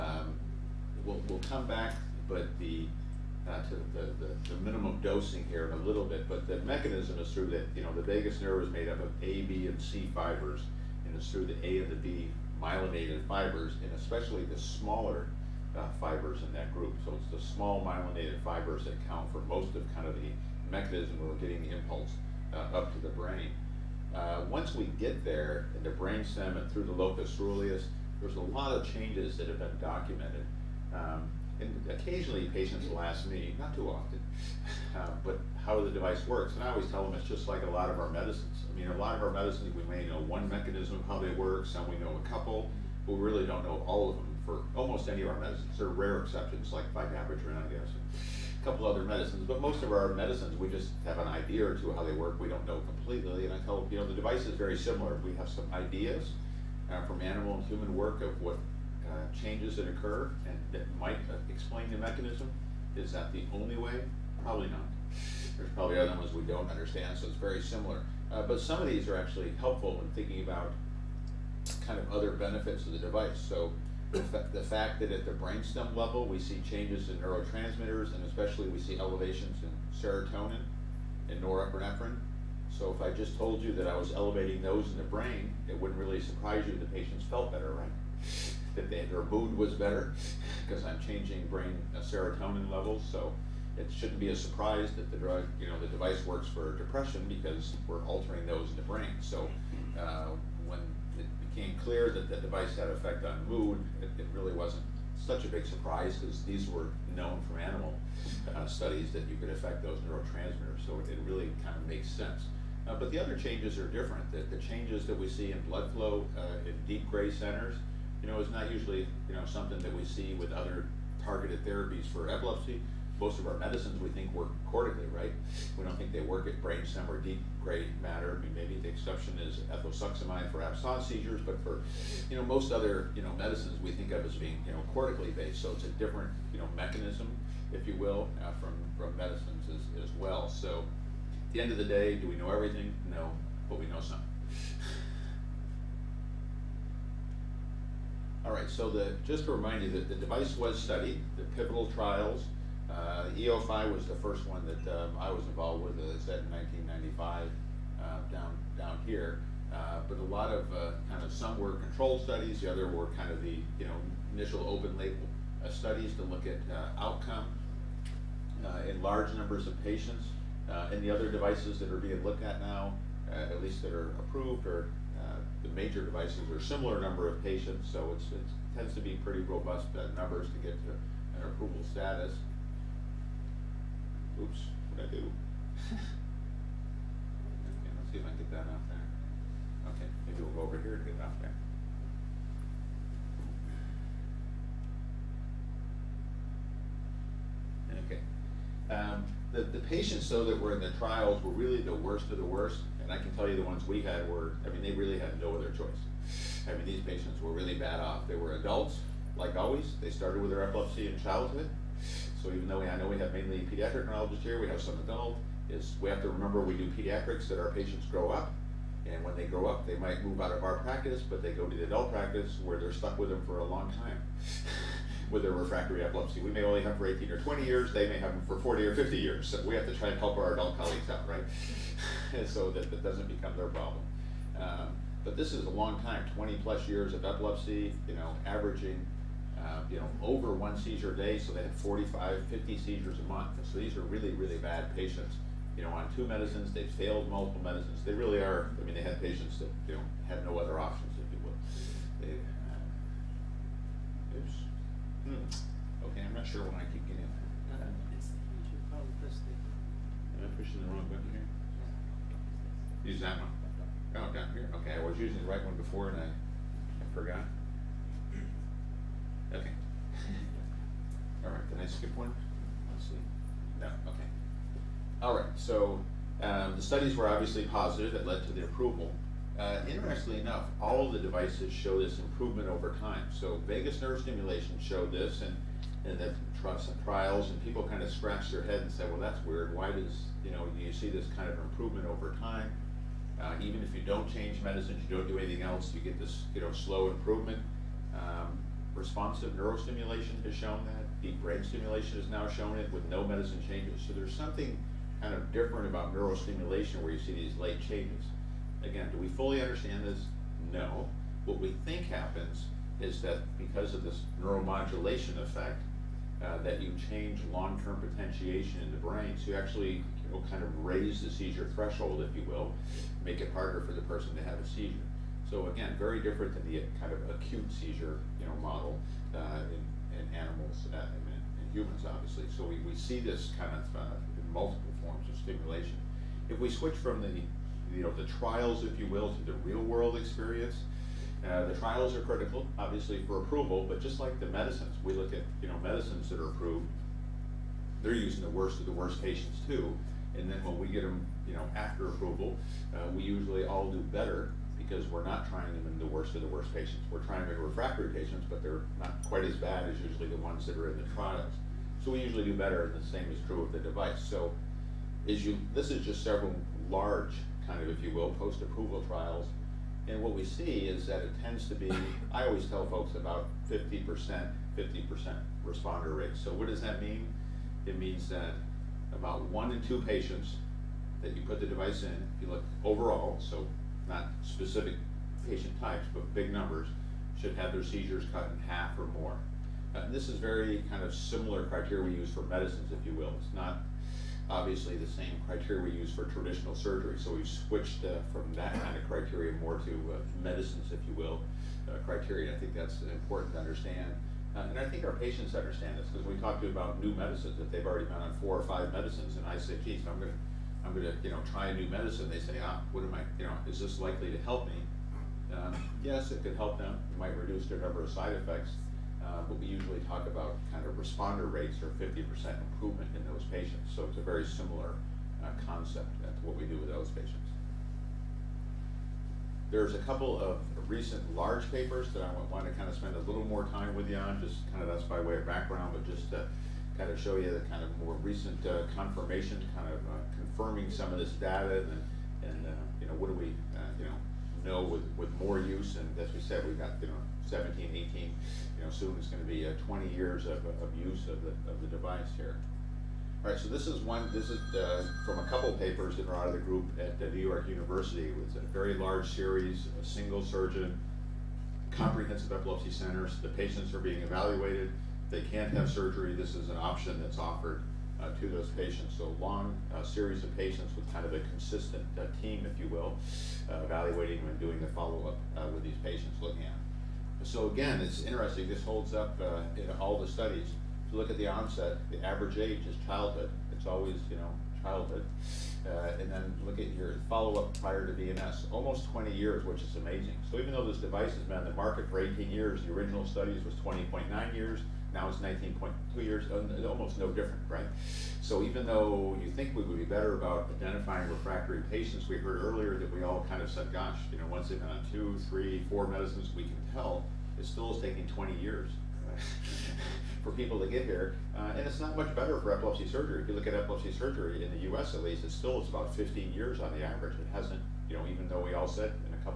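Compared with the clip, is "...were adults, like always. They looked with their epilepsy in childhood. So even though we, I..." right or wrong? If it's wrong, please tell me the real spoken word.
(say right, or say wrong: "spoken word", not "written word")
wrong: "started", not "looked".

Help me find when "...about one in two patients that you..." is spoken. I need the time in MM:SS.
06:19.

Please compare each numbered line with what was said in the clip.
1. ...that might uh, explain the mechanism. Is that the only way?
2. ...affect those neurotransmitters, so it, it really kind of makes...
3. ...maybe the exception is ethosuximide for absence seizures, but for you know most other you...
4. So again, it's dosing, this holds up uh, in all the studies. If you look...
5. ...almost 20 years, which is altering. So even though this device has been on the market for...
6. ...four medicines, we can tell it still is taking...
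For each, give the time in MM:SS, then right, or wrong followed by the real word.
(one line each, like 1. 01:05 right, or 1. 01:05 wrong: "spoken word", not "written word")
1. 01:00 right
2. 01:49 right
3. 02:08 right
4. 07:57 wrong: "interesting", not "dosing"
5. 08:08 wrong: "amazing", not "altering"
6. 08:25 right.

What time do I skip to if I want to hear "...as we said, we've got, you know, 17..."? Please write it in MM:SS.
07:26.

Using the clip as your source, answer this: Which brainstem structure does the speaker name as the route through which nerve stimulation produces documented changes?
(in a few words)
locus coeruleus.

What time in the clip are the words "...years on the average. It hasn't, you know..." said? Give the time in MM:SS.
08:36.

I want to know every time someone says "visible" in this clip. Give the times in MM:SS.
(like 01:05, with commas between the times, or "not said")
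not said.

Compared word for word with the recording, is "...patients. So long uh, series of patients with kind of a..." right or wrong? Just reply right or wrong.
right.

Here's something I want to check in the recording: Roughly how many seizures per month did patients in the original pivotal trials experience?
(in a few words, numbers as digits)
45 to 50.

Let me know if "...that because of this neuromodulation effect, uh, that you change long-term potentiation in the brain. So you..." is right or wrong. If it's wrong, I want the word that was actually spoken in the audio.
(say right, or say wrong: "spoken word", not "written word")
right.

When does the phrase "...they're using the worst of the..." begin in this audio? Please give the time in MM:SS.
05:48.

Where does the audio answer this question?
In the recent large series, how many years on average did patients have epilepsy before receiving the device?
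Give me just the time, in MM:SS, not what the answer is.
08:15.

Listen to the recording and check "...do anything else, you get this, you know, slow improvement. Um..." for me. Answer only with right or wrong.
right.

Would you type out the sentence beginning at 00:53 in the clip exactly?
And I tell you know the device is very similar.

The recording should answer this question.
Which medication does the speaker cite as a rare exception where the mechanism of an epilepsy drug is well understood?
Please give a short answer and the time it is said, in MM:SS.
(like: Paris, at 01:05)
vigabatrin, at 00:46.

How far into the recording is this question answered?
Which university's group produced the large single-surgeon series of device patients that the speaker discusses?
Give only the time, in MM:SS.
07:37.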